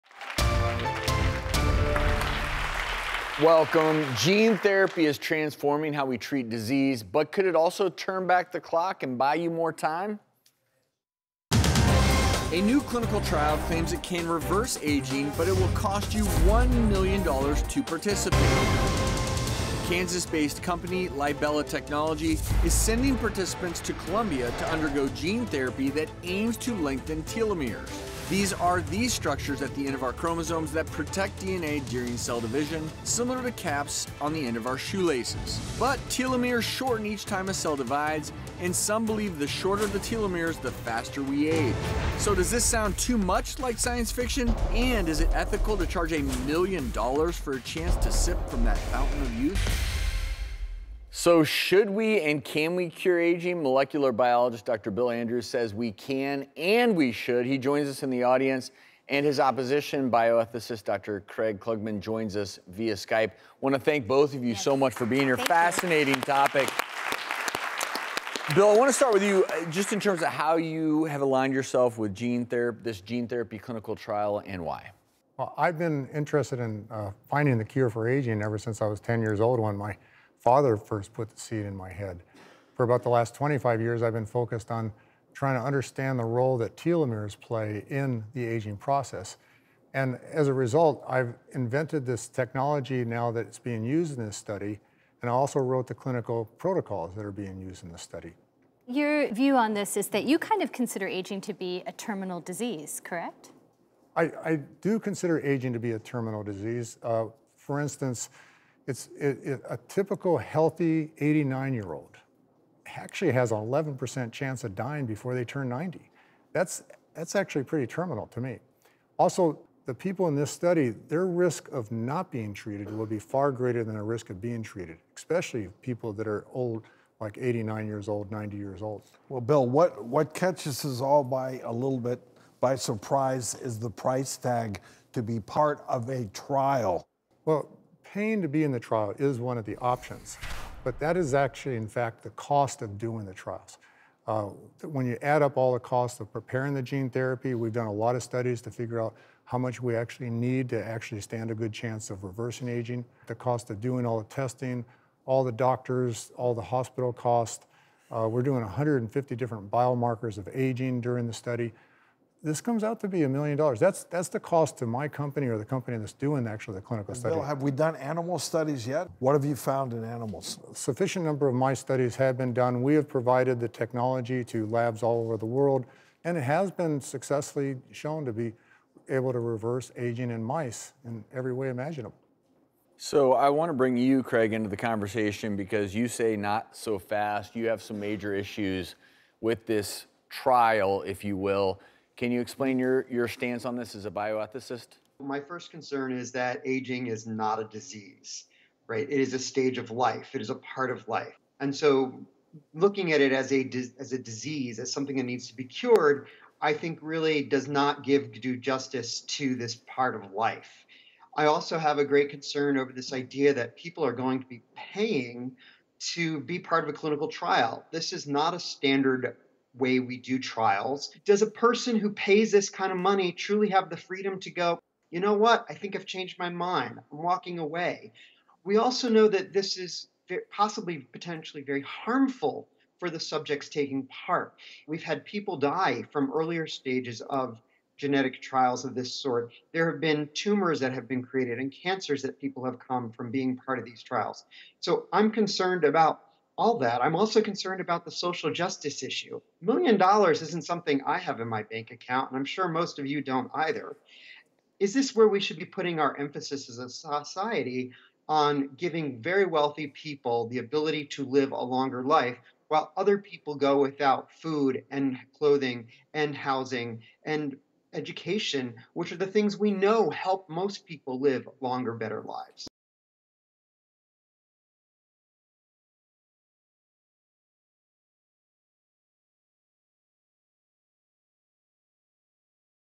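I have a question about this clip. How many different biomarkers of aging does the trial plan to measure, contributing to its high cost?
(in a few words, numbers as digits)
150.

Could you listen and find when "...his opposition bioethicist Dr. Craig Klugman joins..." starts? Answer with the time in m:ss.
0:59.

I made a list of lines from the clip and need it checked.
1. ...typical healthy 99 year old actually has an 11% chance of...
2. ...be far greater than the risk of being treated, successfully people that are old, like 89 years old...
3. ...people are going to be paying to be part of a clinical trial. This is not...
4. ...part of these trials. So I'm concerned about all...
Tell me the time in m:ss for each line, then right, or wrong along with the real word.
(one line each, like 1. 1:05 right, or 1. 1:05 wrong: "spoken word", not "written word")
1. 1:49 wrong: "89", not "99"
2. 2:03 wrong: "especially", not "successfully"
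3. 3:33 right
4. 4:03 right.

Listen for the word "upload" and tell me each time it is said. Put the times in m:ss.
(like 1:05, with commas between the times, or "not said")
not said.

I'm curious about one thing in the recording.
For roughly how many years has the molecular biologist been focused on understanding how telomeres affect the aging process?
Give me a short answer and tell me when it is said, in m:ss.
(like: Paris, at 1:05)
25 years, at 1:23.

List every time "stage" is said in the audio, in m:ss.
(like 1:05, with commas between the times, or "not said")
3:19, 3:56.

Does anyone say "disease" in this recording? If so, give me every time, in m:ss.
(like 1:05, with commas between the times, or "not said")
0:06, 1:42, 1:46, 3:17, 3:24.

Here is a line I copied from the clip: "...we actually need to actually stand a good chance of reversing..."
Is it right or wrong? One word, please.
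right.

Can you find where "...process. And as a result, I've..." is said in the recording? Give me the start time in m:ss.
1:28.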